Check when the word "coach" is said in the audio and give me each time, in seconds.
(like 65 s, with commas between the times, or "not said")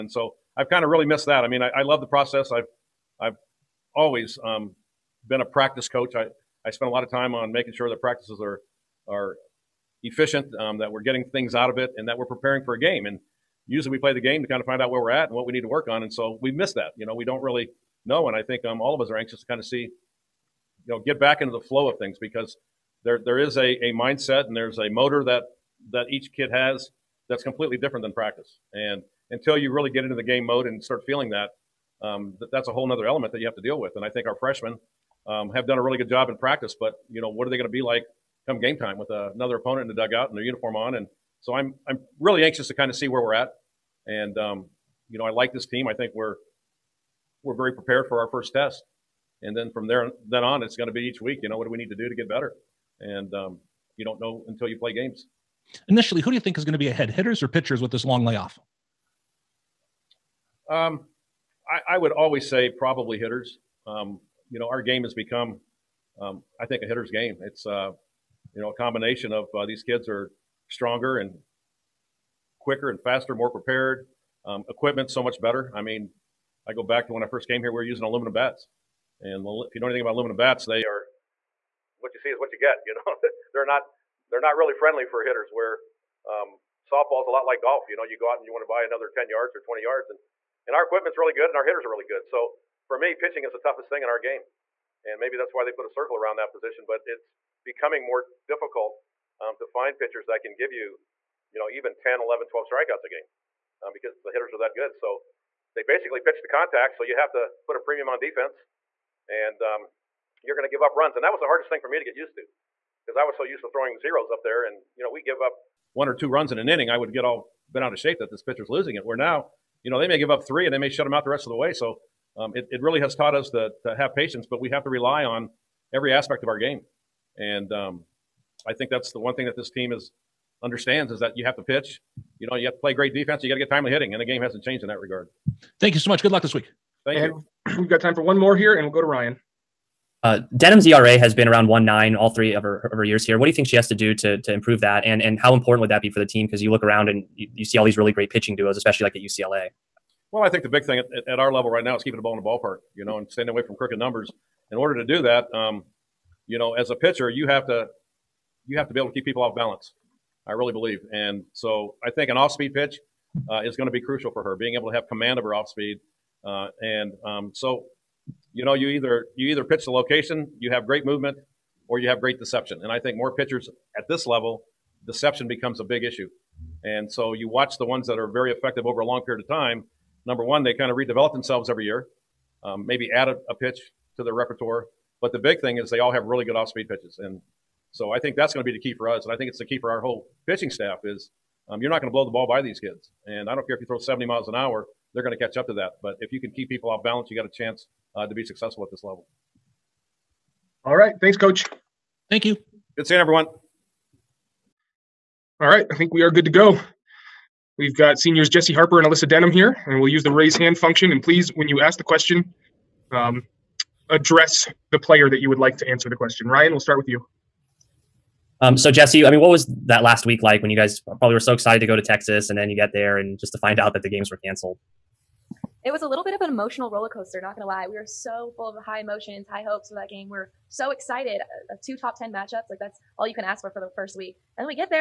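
5 s, 201 s.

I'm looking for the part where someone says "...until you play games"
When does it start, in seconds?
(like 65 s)
54 s.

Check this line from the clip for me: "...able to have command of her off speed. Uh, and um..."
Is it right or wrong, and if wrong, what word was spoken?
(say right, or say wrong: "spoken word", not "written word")
right.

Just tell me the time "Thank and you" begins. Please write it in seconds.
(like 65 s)
137 s.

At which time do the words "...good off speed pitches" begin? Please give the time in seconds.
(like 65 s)
186 s.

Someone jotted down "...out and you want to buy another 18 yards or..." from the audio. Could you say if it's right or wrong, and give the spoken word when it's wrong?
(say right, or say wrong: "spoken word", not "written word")
wrong: "10", not "18".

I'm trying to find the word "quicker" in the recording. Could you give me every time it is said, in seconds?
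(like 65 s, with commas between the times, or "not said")
72 s.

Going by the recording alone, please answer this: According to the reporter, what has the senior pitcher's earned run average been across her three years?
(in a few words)
Around 1.9.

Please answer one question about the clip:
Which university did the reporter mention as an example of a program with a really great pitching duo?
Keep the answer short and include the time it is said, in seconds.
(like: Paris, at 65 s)
UCLA, at 149 s.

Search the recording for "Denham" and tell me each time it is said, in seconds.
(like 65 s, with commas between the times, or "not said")
140 s, 209 s.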